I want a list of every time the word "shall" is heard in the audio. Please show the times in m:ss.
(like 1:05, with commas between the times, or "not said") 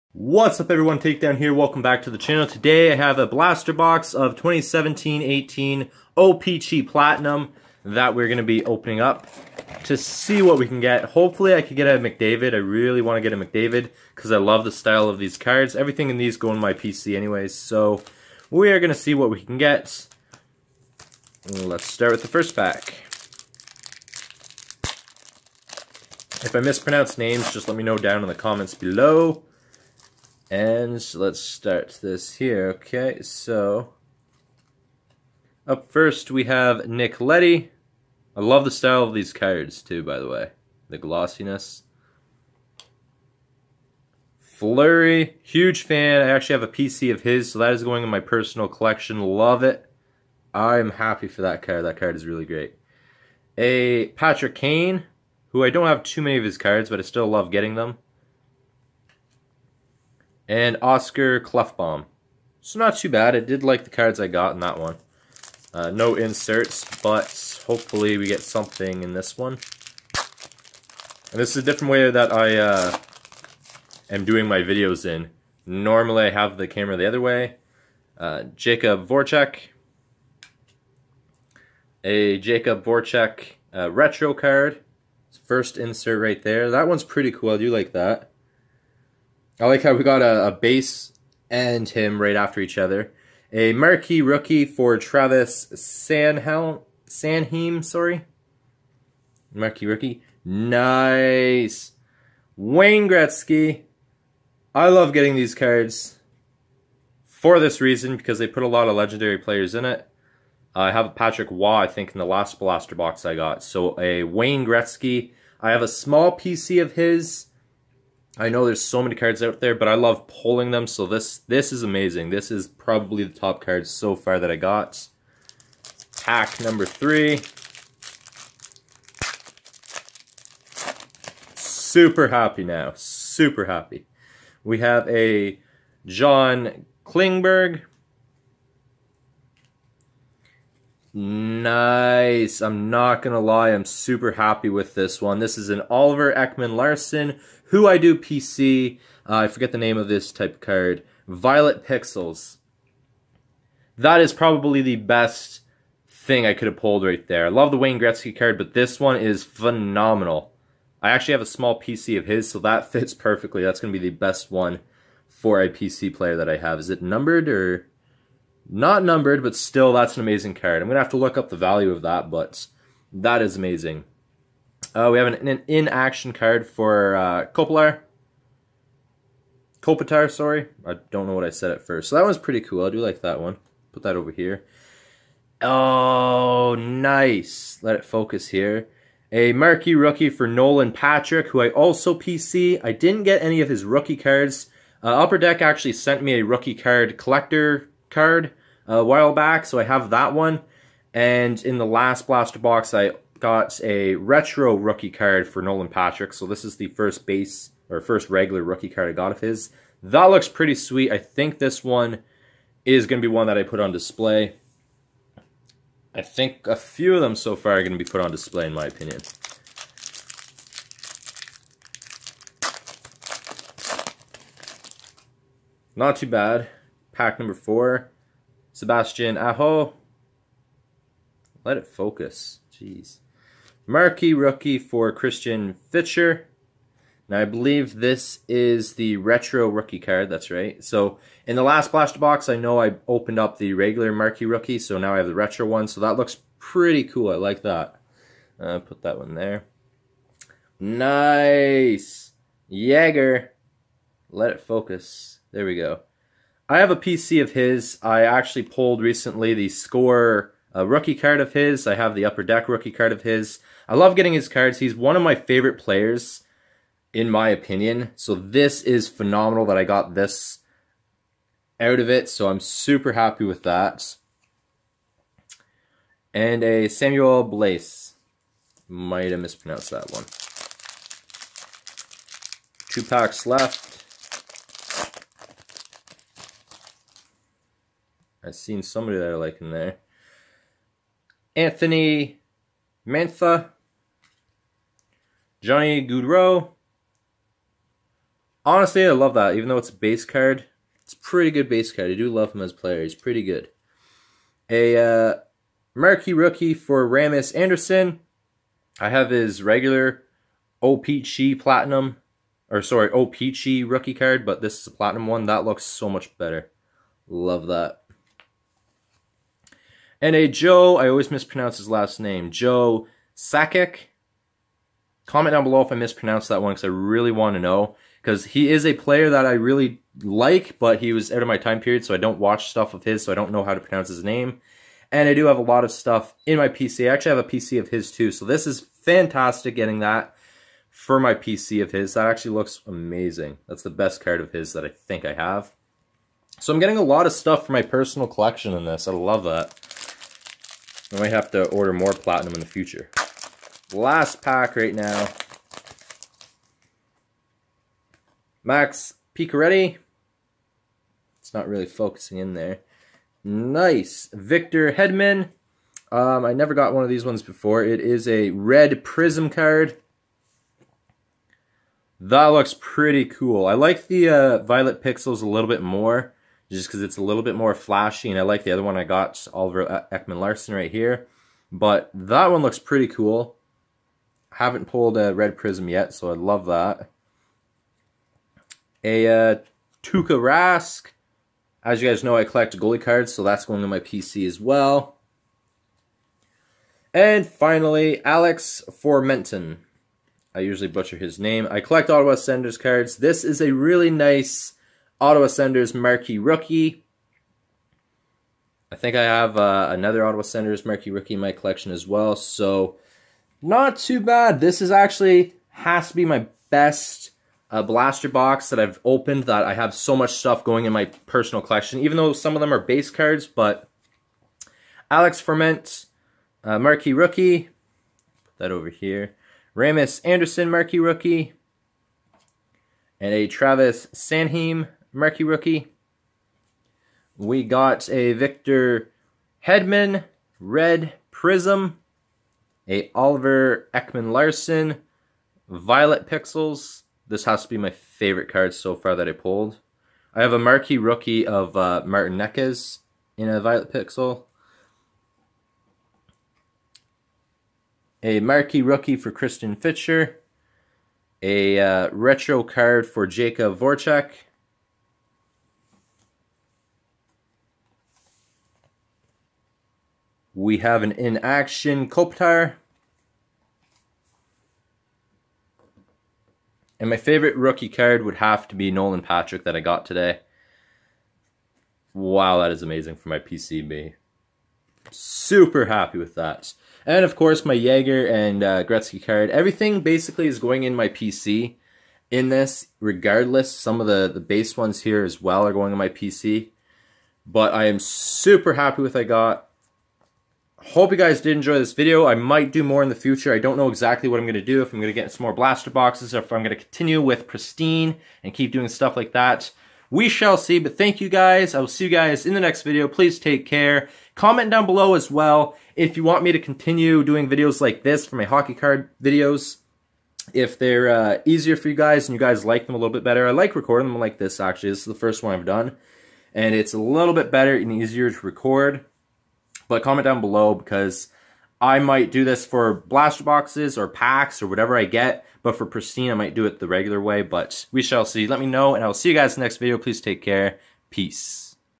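8:30, 8:58.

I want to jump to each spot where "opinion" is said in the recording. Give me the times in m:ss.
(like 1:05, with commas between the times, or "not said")
3:38, 4:27.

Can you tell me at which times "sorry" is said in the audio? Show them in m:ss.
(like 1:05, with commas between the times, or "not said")
1:37, 3:00, 5:12.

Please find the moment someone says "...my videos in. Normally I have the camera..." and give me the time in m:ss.
1:14.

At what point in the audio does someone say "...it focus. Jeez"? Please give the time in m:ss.
3:51.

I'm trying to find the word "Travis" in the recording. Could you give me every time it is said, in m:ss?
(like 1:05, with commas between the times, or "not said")
1:34, 7:13.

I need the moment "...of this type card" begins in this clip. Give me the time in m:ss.
2:29.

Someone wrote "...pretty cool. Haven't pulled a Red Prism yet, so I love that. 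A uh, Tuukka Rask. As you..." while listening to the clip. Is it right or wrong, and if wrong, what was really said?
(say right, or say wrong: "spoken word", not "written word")
right.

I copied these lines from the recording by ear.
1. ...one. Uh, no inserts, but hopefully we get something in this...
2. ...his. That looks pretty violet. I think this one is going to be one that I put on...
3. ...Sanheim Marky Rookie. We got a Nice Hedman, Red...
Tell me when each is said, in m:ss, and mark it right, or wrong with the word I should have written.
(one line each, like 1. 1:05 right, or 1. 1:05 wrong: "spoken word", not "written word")
1. 1:04 right
2. 3:29 wrong: "sweet", not "violet"
3. 7:14 wrong: "Victor", not "Nice".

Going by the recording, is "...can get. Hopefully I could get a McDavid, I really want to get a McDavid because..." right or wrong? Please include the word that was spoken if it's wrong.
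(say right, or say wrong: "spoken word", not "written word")
right.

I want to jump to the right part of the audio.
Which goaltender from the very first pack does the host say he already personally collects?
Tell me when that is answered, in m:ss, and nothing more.
0:44.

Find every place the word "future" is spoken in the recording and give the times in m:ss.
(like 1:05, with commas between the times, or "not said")
5:52, 8:23.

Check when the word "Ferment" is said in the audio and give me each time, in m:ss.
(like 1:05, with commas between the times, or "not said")
7:05.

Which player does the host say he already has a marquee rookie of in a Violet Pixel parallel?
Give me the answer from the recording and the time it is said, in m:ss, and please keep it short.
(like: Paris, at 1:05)
Martin Necas, at 7:32.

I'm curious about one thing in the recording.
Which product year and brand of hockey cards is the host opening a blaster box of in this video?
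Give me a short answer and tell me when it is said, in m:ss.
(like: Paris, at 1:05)
2017-18 OPC Platinum, at 0:04.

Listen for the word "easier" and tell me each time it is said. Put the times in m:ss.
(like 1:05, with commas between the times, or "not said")
8:41, 8:47.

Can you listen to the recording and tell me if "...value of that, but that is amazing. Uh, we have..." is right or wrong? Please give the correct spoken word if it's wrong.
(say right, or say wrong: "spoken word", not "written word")
right.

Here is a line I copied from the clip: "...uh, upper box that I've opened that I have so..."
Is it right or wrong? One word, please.
wrong.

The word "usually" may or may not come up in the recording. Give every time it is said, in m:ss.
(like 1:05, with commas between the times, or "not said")
6:40.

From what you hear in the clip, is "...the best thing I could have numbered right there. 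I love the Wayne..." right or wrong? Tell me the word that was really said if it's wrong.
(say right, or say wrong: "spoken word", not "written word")
wrong: "pulled", not "numbered".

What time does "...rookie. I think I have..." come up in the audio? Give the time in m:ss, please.
6:46.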